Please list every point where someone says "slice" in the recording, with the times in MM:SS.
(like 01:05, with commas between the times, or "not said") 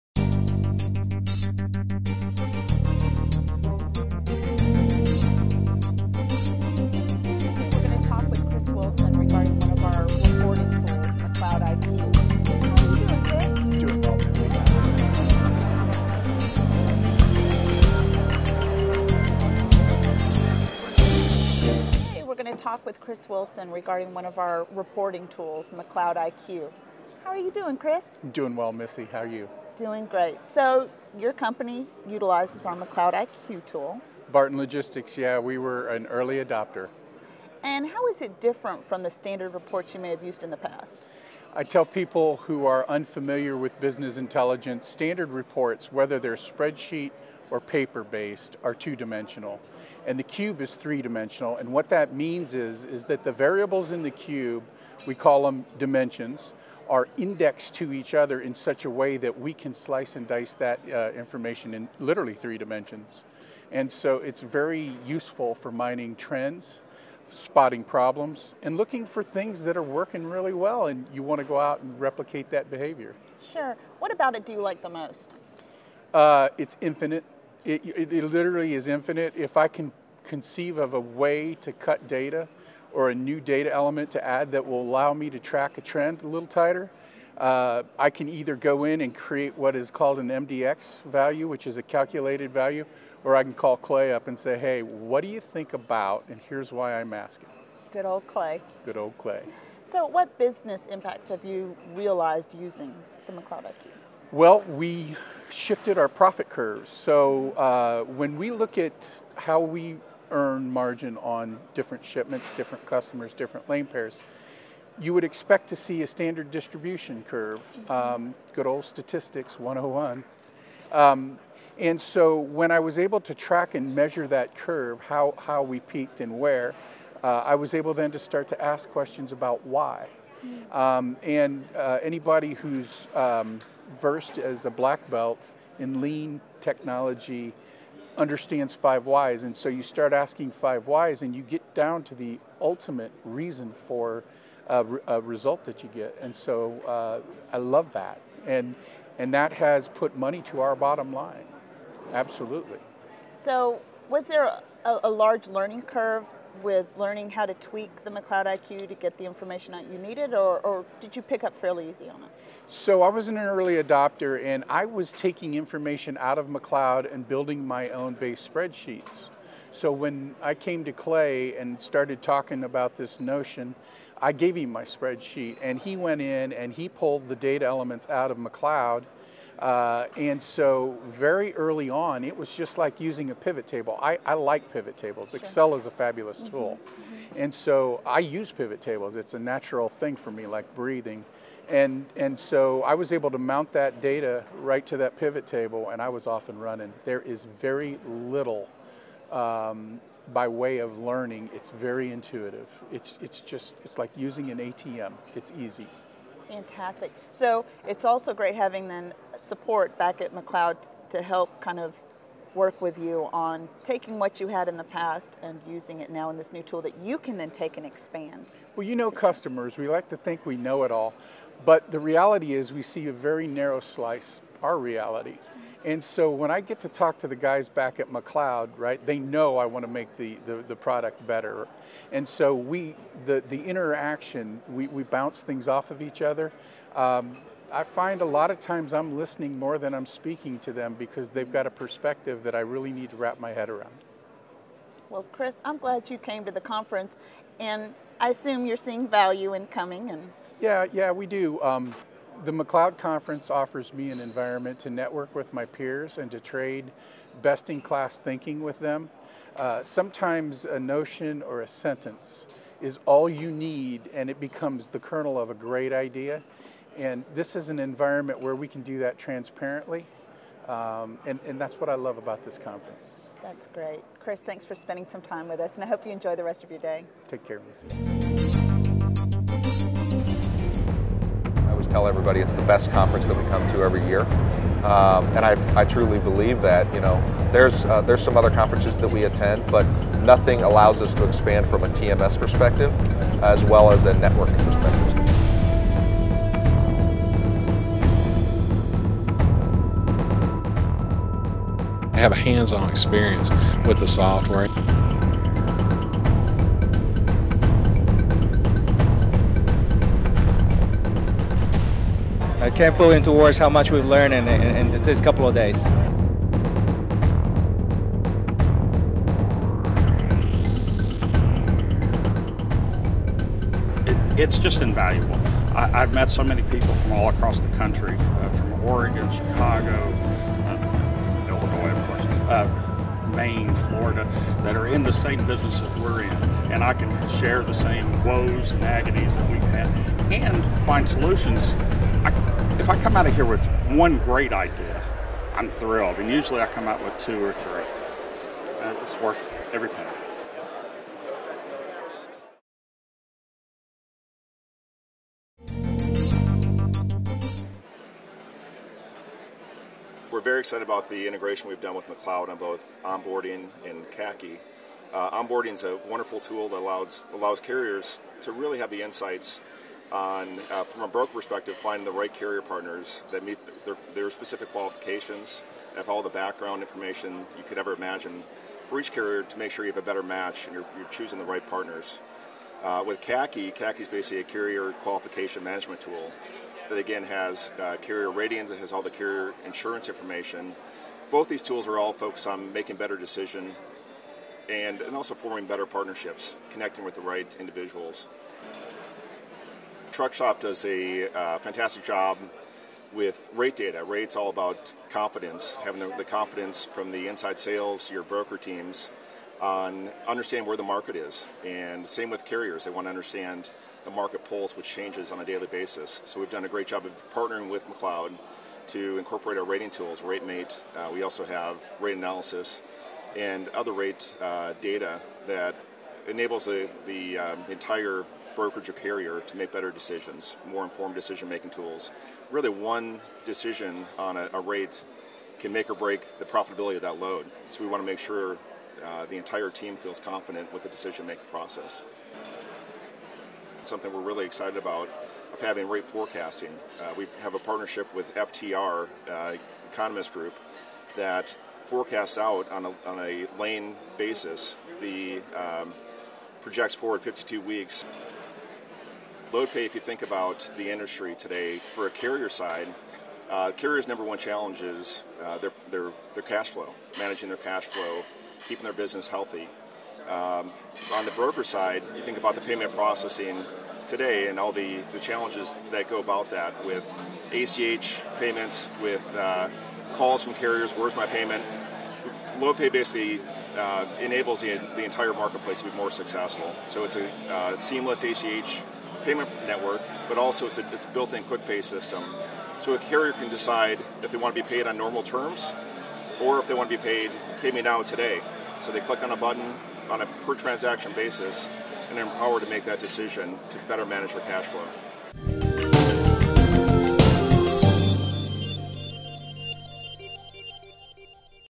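00:59, 03:43.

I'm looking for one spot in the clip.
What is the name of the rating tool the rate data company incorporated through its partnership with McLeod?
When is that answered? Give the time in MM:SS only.
07:00.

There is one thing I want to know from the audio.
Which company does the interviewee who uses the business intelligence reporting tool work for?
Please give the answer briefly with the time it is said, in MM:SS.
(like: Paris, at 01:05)
Barton Logistics, at 00:34.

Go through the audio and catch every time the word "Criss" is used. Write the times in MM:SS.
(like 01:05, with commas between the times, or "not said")
00:23, 00:27, 04:05, 04:34.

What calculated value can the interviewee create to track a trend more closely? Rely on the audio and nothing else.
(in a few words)
MDX value.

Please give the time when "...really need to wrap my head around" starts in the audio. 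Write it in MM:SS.
04:02.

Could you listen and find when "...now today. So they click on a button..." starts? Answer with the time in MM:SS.
08:17.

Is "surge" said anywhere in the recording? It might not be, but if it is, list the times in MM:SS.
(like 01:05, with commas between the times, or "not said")
not said.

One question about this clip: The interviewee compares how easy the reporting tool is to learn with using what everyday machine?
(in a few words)
an ATM.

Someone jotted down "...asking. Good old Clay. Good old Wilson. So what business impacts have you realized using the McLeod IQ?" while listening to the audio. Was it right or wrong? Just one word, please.
wrong.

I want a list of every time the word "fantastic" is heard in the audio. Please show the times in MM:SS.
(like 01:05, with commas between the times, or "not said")
03:26, 06:41.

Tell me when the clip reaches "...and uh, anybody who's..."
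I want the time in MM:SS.
02:11.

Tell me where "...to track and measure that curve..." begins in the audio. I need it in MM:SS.
02:03.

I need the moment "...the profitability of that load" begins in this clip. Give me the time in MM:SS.
07:16.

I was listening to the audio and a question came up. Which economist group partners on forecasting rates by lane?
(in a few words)
FTR.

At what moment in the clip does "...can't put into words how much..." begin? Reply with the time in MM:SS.
05:12.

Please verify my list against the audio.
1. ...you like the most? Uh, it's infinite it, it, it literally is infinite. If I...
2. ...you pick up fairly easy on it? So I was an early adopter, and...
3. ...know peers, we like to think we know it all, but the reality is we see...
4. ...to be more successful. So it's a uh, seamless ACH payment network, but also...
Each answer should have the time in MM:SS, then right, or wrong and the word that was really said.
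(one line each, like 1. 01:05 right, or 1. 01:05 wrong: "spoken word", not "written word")
1. 01:14 right
2. 02:41 right
3. 03:38 wrong: "customers", not "peers"
4. 08:05 right.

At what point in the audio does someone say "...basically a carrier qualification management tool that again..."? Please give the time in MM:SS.
06:24.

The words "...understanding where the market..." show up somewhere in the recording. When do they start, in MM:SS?
06:50.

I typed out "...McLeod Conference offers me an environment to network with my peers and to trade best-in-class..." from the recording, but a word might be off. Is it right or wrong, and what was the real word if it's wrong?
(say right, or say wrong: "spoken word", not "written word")
right.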